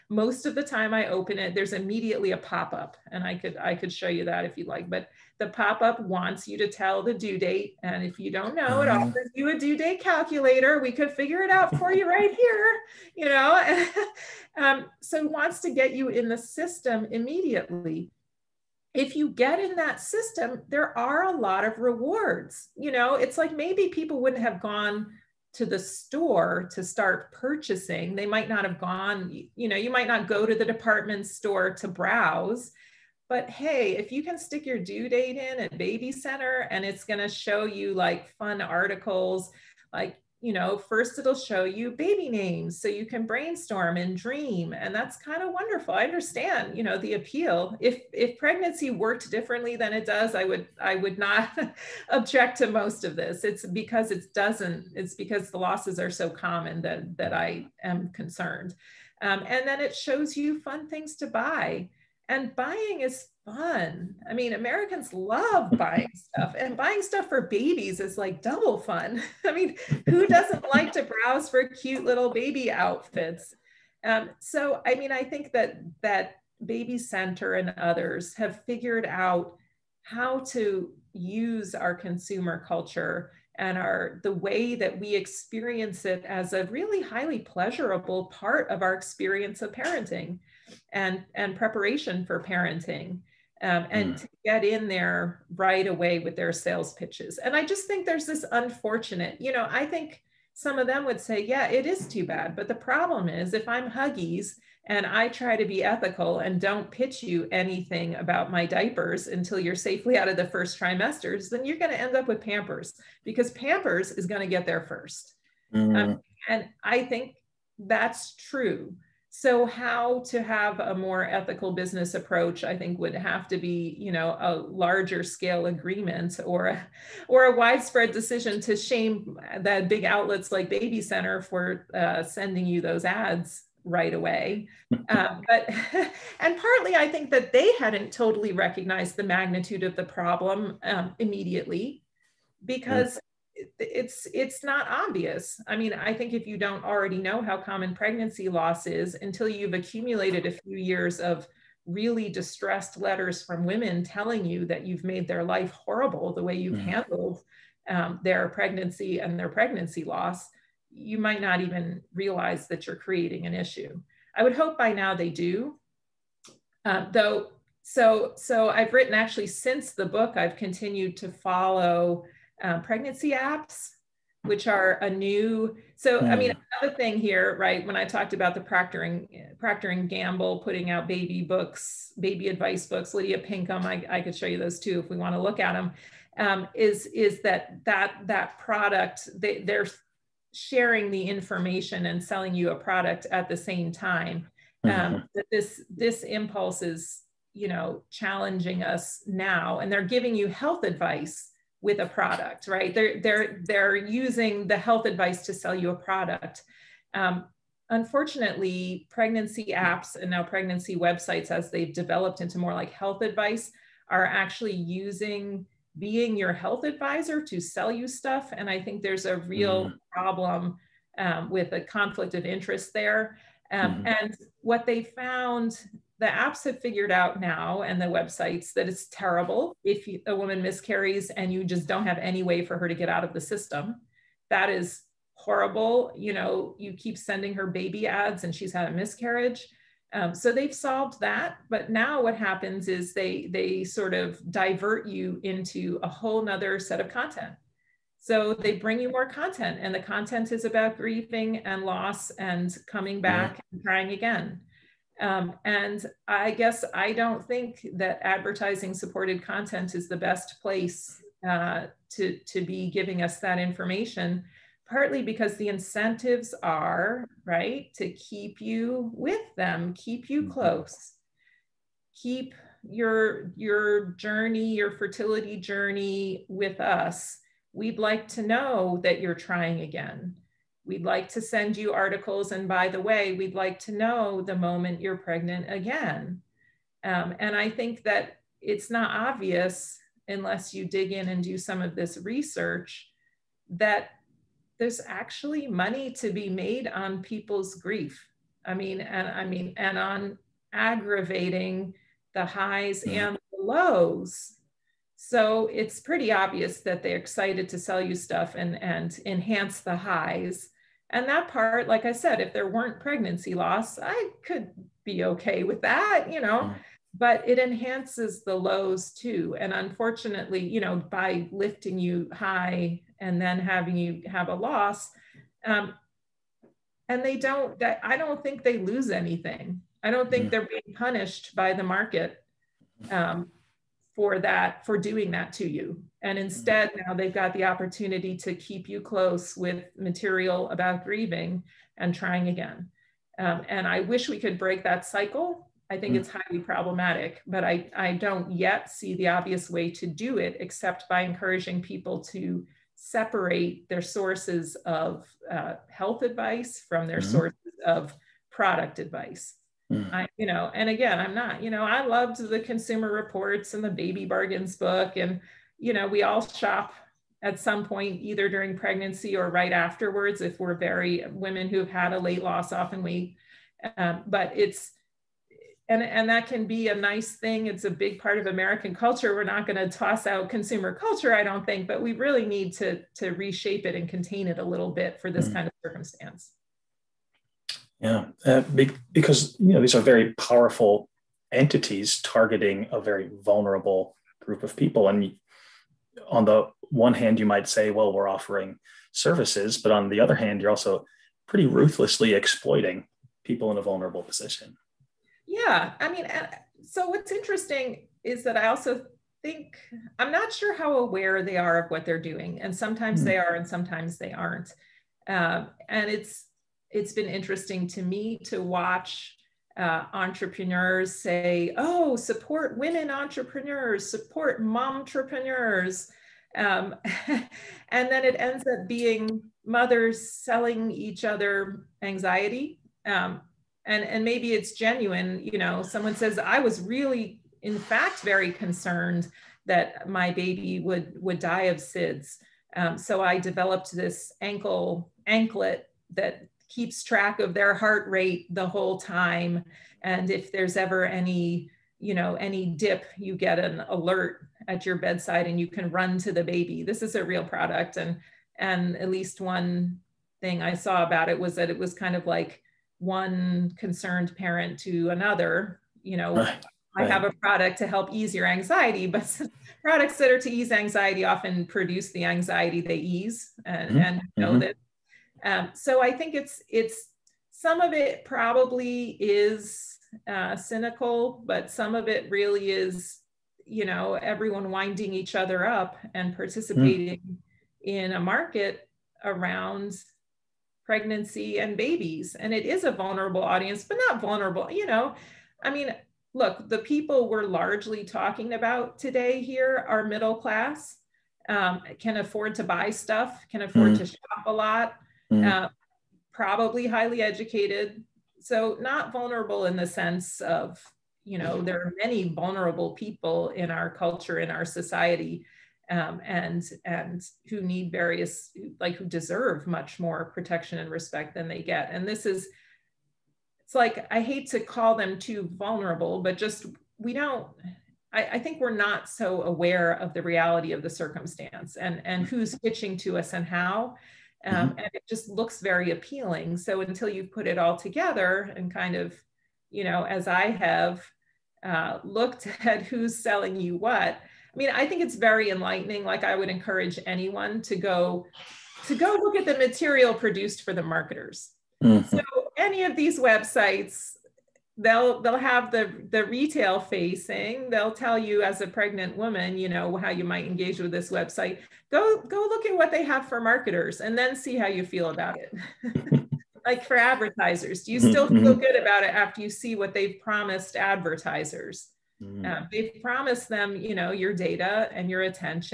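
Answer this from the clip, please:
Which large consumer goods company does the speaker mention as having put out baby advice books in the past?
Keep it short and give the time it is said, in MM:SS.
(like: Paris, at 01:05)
Procter and Gamble, at 02:59.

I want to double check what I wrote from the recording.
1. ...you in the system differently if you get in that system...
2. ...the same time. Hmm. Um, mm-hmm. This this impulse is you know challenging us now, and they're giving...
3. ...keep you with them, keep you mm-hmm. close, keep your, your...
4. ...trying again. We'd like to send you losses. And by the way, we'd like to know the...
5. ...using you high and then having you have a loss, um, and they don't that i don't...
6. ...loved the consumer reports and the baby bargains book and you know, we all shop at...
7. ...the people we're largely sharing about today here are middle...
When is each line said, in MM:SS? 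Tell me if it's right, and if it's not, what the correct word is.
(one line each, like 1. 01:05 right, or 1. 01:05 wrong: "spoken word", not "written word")
1. 00:15 wrong: "immediately", not "differently"
2. 03:13 right
3. 04:28 right
4. 04:39 wrong: "articles", not "losses"
5. 05:21 wrong: "lifting", not "using"
6. 06:02 right
7. 08:16 wrong: "talking", not "sharing".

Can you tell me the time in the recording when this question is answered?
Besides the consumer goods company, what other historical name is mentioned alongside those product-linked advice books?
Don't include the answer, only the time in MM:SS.
03:03.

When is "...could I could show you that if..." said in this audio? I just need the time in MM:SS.
00:03.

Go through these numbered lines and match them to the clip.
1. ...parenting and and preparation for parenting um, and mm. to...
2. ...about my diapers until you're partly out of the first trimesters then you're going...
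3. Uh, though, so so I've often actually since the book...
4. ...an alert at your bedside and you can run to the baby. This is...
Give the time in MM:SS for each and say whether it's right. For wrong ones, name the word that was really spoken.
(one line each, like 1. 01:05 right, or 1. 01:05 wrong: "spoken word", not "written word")
1. 01:29 right
2. 01:48 wrong: "safely", not "partly"
3. 02:46 wrong: "written", not "often"
4. 07:33 right.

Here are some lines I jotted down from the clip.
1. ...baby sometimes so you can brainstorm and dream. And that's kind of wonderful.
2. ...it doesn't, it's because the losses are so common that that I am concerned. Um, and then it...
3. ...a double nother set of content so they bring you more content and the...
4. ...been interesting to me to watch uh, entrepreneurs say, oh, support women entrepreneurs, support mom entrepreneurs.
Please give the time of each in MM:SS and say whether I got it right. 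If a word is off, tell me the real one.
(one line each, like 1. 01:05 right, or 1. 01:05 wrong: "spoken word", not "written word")
1. 00:41 wrong: "names", not "sometimes"
2. 00:54 right
3. 04:06 wrong: "whole", not "double"
4. 06:57 right.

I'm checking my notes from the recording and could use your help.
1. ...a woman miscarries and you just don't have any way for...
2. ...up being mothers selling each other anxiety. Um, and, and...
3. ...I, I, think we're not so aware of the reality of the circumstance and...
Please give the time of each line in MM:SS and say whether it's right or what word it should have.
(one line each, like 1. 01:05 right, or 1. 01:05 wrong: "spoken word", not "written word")
1. 03:50 right
2. 07:08 right
3. 08:48 right.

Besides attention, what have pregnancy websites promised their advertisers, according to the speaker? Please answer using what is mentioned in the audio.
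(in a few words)
your data.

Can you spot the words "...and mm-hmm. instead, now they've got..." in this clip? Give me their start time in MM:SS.
05:36.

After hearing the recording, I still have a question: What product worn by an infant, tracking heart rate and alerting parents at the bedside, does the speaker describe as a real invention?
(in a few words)
anklet.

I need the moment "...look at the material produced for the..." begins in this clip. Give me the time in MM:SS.
09:09.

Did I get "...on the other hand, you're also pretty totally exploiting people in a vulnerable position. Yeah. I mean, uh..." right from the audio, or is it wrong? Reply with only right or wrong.
wrong.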